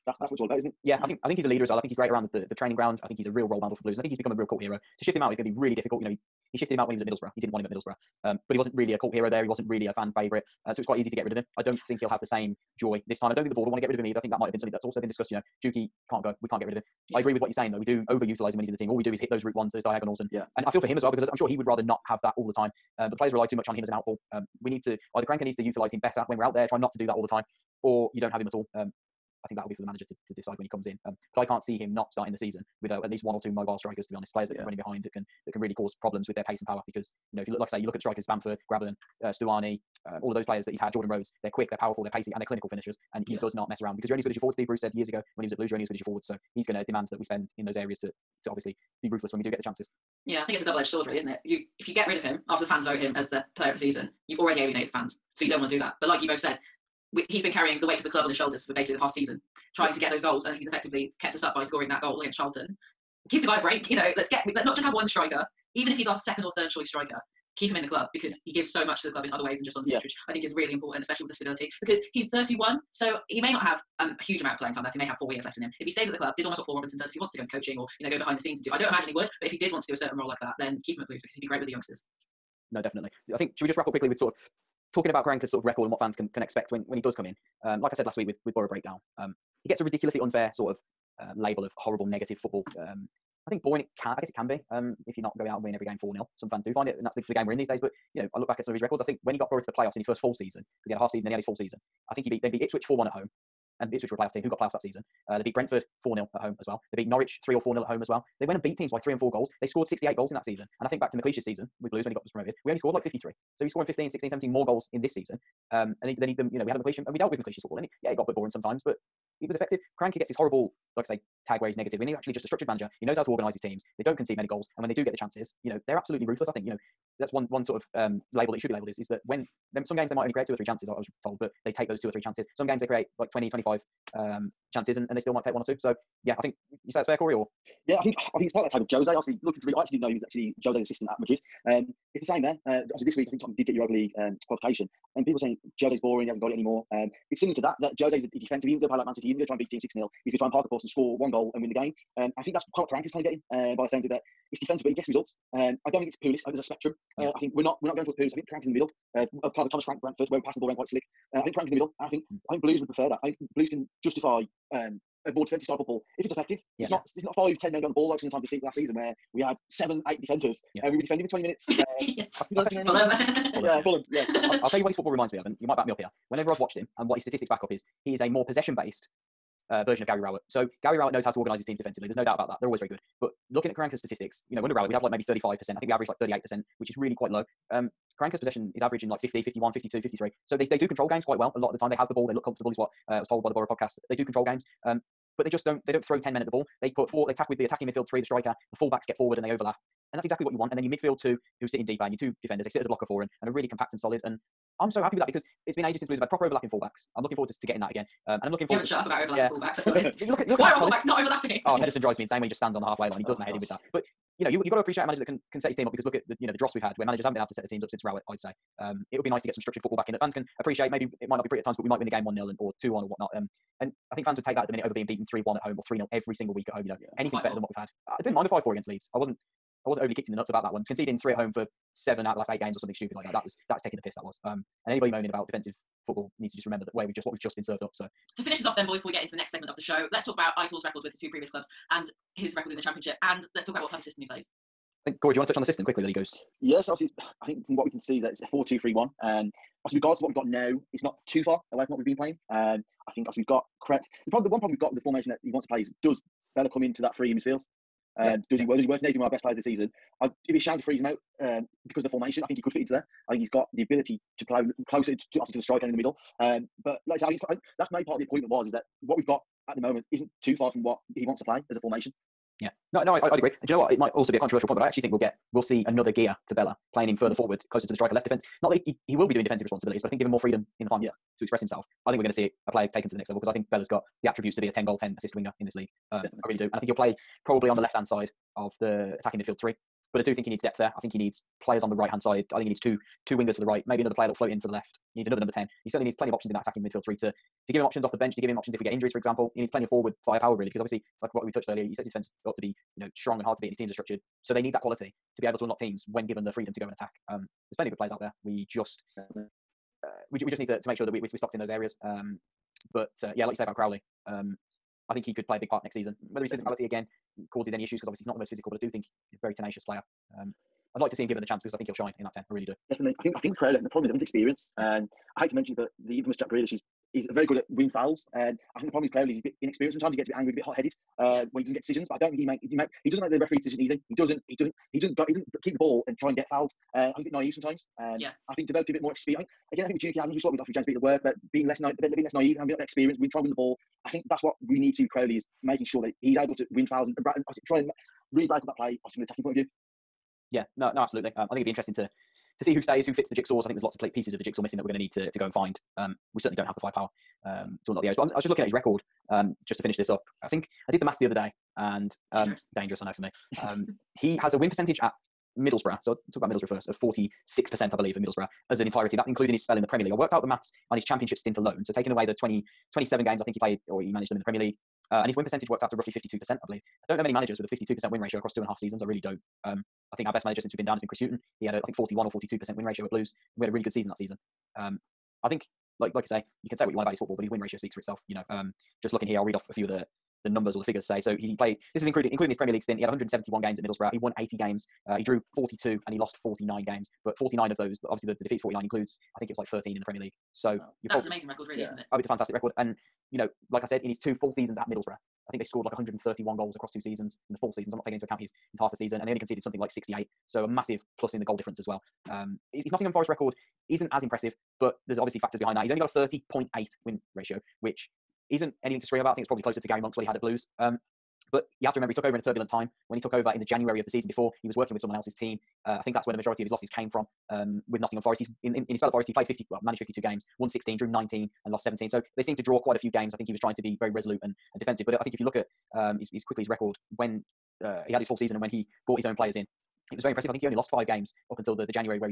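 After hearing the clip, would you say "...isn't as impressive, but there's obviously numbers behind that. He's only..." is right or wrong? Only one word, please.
wrong.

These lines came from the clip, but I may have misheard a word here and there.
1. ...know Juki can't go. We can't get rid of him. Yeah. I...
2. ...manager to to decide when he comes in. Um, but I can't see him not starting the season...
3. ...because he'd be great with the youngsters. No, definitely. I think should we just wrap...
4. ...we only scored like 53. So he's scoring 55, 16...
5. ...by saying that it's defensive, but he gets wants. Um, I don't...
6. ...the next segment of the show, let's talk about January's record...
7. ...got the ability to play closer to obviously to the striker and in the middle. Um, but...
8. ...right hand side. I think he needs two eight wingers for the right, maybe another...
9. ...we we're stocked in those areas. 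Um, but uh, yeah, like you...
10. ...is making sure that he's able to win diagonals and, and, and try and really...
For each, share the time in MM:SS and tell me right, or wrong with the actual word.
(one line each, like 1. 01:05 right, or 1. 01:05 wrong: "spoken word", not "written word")
1. 00:15 right
2. 00:29 right
3. 01:21 right
4. 01:52 wrong: "15", not "55"
5. 02:33 wrong: "results", not "wants"
6. 03:59 wrong: "Aitor", not "January"
7. 04:23 right
8. 04:51 wrong: "two", not "eight"
9. 05:11 right
10. 05:45 wrong: "fouls", not "diagonals".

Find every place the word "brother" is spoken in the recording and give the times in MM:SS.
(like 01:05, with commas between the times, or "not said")
not said.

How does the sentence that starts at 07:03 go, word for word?
When he took over in the January of the season before, he was working with someone else's team.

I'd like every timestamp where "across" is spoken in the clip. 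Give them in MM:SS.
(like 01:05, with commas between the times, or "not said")
06:18, 06:46.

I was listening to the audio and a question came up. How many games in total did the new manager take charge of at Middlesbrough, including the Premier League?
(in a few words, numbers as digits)
171.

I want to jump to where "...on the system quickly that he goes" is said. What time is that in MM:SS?
04:05.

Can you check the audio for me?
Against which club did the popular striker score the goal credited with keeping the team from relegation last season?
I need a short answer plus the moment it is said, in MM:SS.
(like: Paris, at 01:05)
Charlton, at 01:02.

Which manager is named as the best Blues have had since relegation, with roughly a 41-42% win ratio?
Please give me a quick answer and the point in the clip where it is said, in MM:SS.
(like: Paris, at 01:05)
Chris Hughton, at 06:21.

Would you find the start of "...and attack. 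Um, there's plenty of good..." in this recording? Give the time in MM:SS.
05:06.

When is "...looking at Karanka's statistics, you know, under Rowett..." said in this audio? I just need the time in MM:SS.
03:03.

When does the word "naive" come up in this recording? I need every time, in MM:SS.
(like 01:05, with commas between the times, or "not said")
05:37, 05:42.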